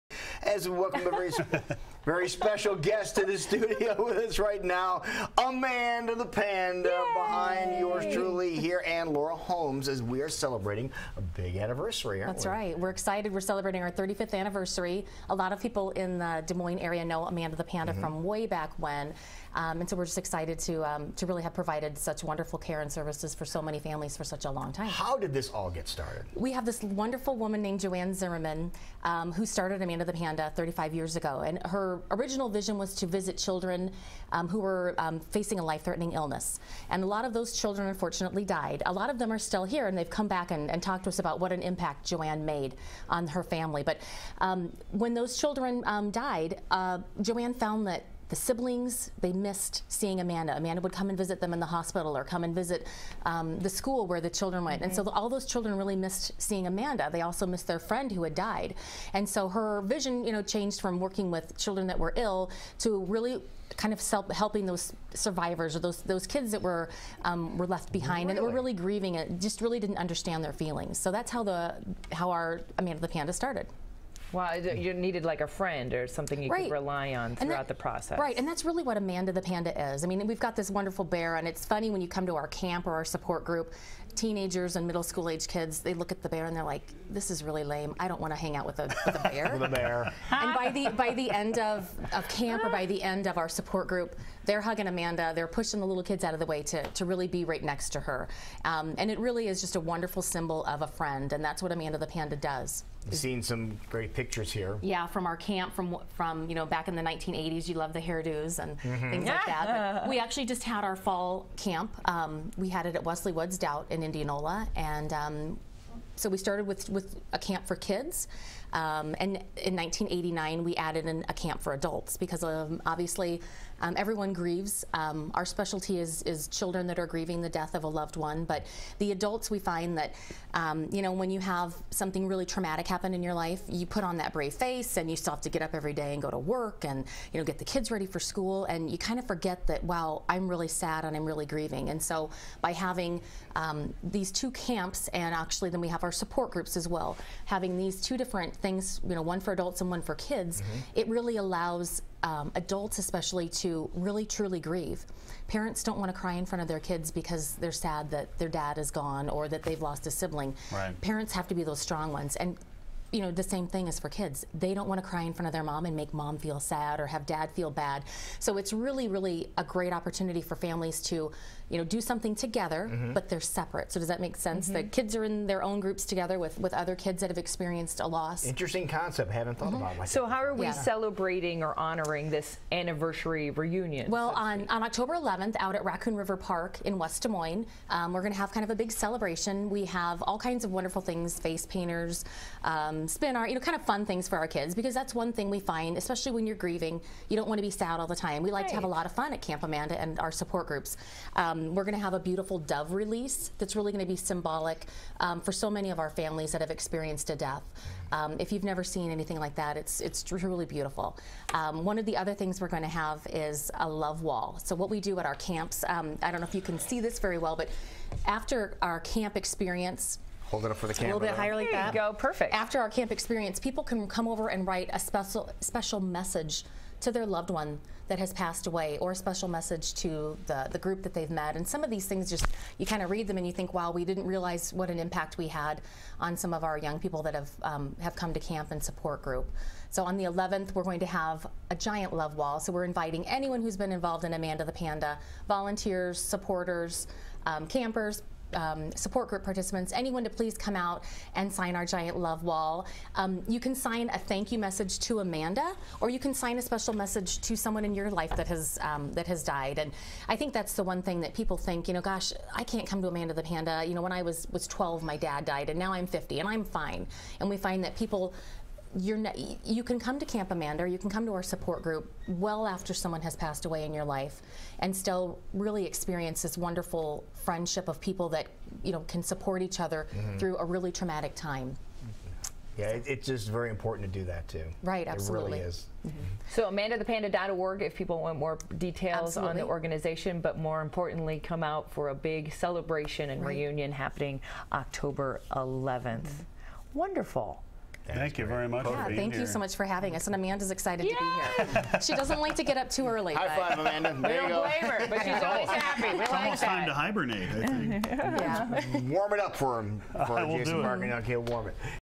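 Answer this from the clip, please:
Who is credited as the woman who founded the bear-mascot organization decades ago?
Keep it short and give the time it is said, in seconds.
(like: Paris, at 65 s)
Joanne Zimmerman, at 27 s.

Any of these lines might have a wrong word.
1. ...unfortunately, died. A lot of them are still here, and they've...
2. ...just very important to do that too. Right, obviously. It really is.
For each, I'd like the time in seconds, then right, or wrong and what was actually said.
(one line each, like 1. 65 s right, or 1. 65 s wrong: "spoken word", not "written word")
1. 37 s right
2. 283 s wrong: "absolutely", not "obviously".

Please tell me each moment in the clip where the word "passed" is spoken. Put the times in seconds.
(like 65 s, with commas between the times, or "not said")
228 s, 273 s.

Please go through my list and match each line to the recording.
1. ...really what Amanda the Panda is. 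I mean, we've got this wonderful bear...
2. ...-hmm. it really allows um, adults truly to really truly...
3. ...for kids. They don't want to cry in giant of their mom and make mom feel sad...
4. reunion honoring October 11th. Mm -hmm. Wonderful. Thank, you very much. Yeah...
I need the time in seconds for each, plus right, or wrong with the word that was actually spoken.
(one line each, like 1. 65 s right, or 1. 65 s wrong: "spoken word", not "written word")
1. 78 s right
2. 150 s wrong: "especially", not "truly"
3. 163 s wrong: "front", not "giant"
4. 293 s wrong: "happening", not "honoring".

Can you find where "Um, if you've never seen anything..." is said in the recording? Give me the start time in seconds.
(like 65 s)
208 s.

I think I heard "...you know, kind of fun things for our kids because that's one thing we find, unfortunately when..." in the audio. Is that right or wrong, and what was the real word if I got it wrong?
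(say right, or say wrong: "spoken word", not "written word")
wrong: "especially", not "unfortunately".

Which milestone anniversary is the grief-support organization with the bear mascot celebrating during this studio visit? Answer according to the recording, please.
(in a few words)
35th.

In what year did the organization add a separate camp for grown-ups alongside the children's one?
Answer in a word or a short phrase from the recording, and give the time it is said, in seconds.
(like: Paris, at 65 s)
1989, at 119 s.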